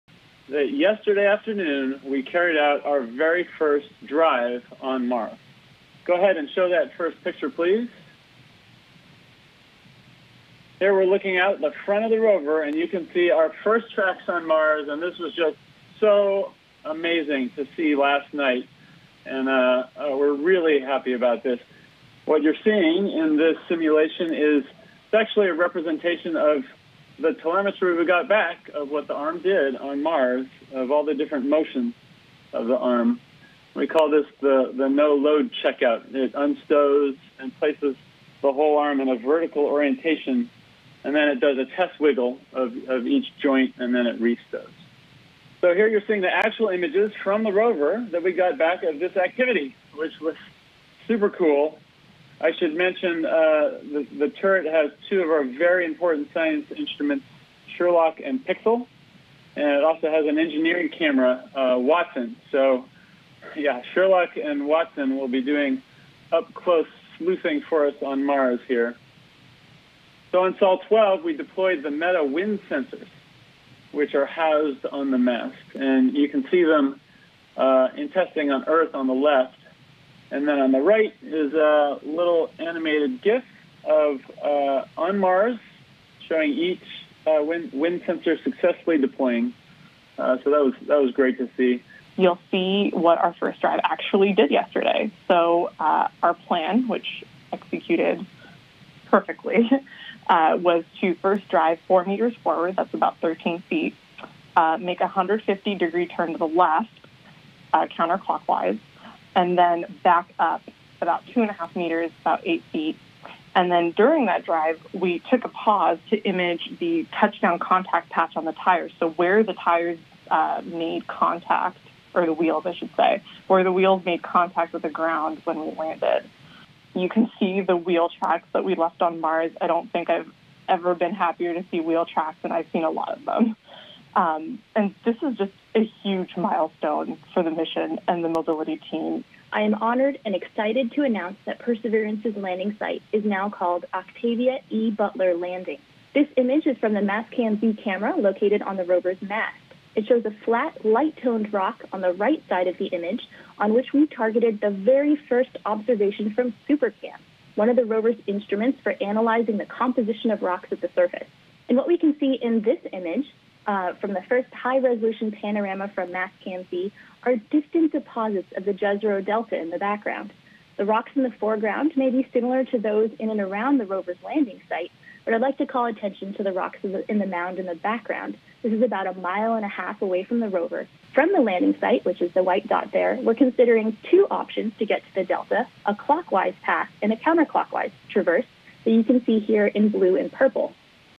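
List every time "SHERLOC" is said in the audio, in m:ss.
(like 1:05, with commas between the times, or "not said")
0:57, 1:03.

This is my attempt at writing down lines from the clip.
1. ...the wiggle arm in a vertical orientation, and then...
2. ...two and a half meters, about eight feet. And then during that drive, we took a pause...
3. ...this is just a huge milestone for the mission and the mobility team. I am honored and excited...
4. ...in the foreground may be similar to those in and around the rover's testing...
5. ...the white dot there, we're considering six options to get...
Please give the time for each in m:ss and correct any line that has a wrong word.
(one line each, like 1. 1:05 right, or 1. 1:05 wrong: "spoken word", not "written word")
1. 0:38 wrong: "whole", not "wiggle"
2. 1:51 right
3. 2:15 right
4. 2:51 wrong: "landing", not "testing"
5. 3:02 wrong: "two", not "six".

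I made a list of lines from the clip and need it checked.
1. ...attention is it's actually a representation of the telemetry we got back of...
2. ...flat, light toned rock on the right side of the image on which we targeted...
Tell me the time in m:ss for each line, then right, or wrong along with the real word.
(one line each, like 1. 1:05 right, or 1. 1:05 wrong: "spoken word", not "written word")
1. 0:23 wrong: "simulation", not "attention"
2. 2:30 right.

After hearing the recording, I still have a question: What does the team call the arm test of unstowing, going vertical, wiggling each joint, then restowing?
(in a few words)
no load checkout.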